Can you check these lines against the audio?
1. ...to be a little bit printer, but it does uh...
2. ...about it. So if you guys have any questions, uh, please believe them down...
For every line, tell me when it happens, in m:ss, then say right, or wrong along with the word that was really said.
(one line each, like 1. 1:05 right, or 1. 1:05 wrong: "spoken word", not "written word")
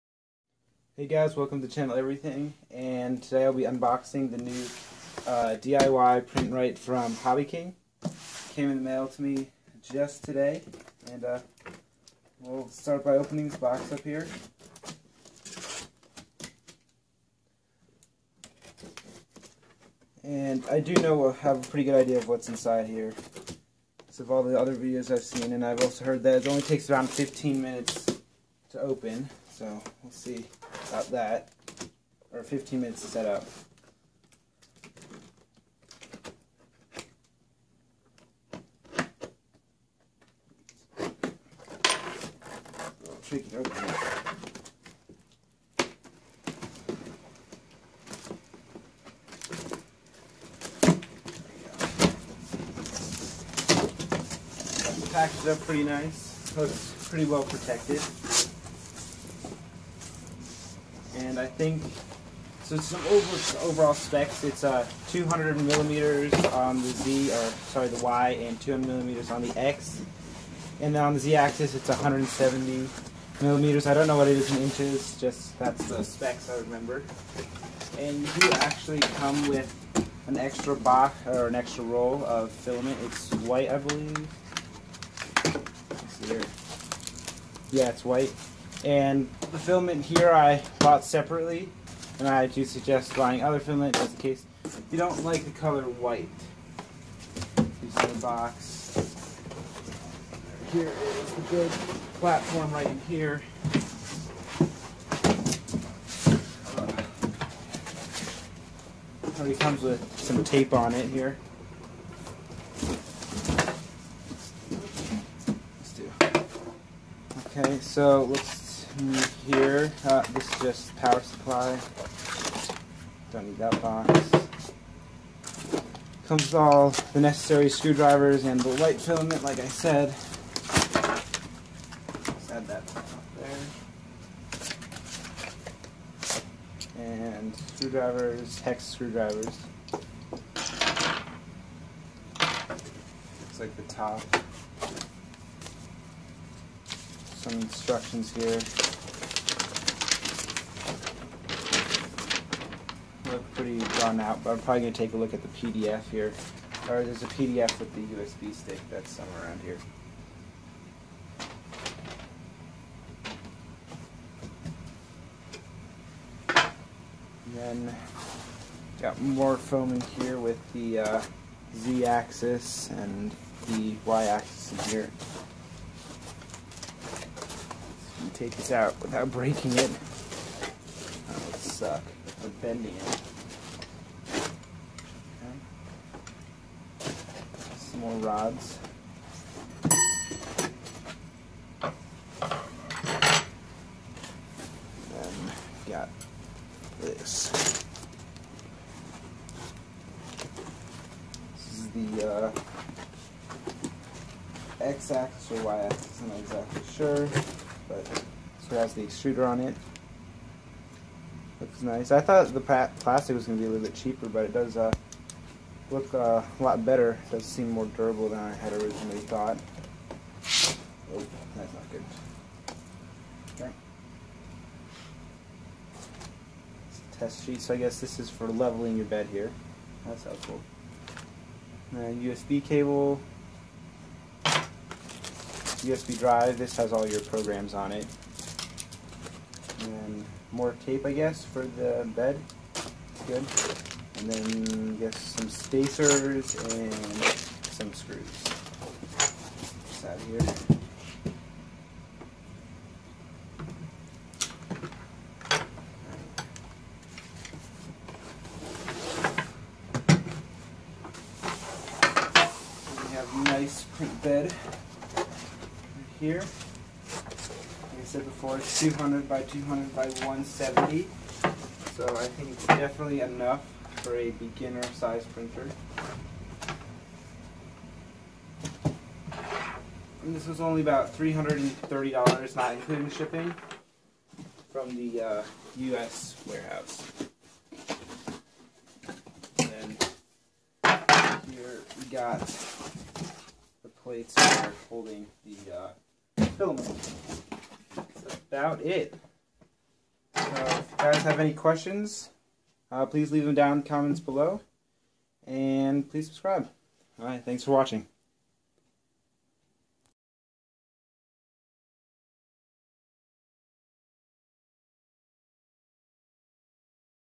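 1. 3:33 wrong: "cheaper", not "printer"
2. 4:58 wrong: "leave", not "believe".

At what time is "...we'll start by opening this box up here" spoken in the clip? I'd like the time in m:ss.
0:12.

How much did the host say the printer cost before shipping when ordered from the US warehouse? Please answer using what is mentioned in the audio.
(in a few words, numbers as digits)
$330.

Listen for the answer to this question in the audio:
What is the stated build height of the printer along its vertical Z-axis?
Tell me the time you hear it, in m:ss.
1:11.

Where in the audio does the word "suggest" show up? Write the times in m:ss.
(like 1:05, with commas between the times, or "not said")
1:32.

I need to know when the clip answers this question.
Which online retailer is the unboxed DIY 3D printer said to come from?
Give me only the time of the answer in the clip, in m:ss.
0:07.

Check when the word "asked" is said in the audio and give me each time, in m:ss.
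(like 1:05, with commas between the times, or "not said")
not said.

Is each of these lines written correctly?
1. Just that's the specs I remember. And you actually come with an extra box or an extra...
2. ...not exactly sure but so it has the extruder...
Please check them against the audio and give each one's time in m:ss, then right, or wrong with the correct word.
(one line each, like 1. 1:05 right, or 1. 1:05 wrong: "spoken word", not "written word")
1. 1:15 right
2. 3:26 right.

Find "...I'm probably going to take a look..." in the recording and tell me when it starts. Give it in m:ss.
2:34.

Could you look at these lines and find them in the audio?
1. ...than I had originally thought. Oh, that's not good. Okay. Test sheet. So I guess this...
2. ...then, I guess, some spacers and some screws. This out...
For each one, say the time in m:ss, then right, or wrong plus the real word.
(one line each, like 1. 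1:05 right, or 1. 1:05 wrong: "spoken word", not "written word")
1. 3:38 right
2. 4:04 right.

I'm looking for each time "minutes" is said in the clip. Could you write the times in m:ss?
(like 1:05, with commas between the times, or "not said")
0:27, 0:32.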